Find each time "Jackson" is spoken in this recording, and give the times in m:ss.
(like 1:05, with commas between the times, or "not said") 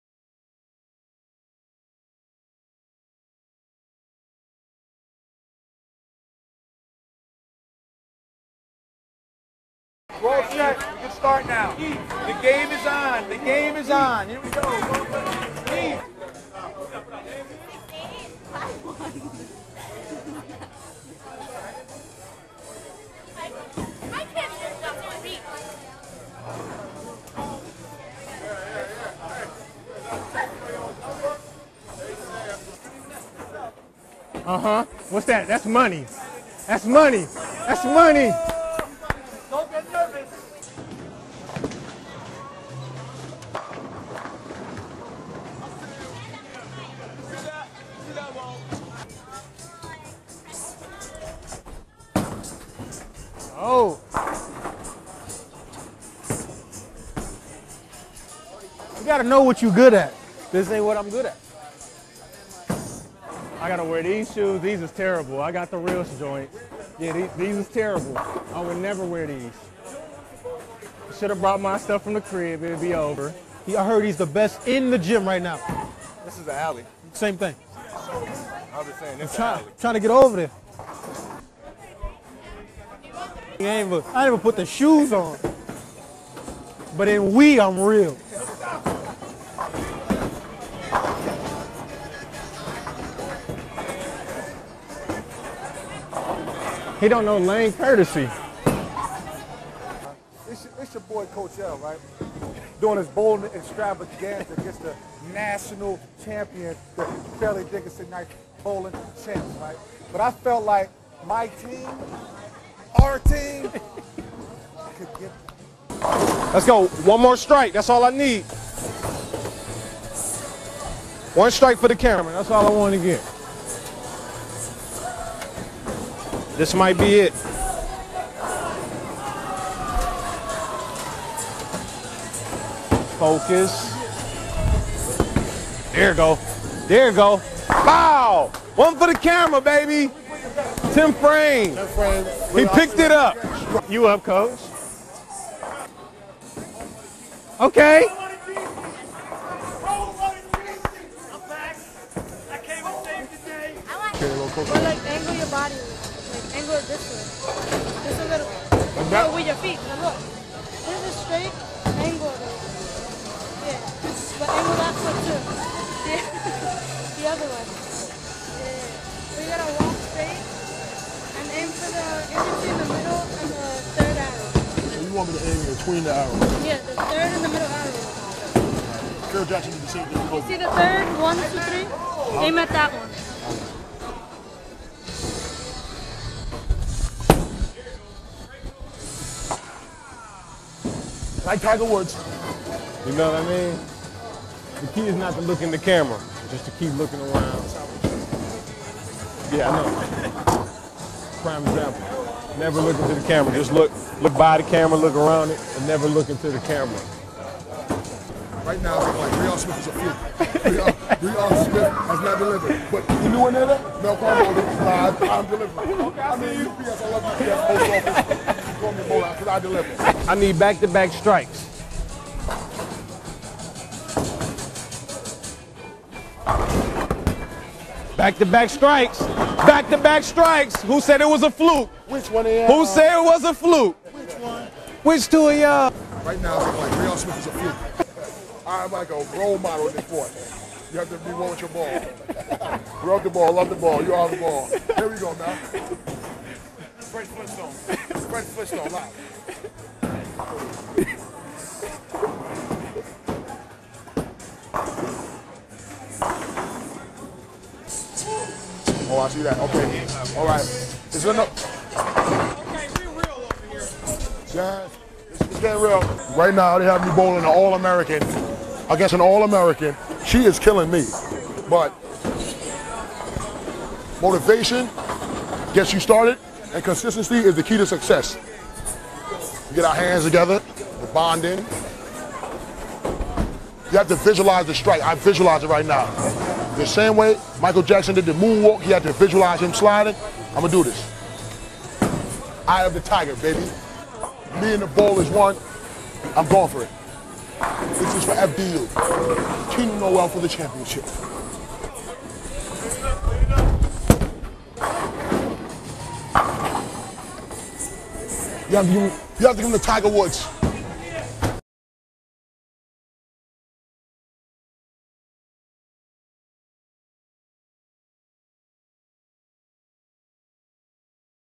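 2:59, 4:47.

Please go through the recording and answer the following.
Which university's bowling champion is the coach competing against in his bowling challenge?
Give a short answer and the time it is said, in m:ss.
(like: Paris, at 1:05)
Fairleigh Dickinson, at 1:47.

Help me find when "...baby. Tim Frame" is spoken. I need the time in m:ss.
2:19.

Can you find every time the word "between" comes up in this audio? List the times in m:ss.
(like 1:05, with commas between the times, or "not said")
2:55.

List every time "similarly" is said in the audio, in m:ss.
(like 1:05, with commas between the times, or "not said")
not said.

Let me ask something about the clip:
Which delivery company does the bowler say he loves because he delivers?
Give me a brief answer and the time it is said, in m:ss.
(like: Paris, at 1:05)
UPS, at 3:36.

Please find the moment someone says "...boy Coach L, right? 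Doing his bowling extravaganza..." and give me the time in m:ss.
1:41.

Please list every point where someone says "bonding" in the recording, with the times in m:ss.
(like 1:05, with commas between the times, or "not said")
4:41.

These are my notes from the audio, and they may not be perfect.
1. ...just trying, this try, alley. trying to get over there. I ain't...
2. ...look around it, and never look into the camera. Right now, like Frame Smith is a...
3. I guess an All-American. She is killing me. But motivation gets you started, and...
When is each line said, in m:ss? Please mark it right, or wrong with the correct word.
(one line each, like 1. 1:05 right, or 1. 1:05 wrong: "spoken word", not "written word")
1. 1:18 wrong: "saying", not "trying"
2. 3:24 wrong: "Real", not "Frame"
3. 4:28 right.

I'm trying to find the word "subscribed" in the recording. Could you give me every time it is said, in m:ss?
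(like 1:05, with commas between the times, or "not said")
not said.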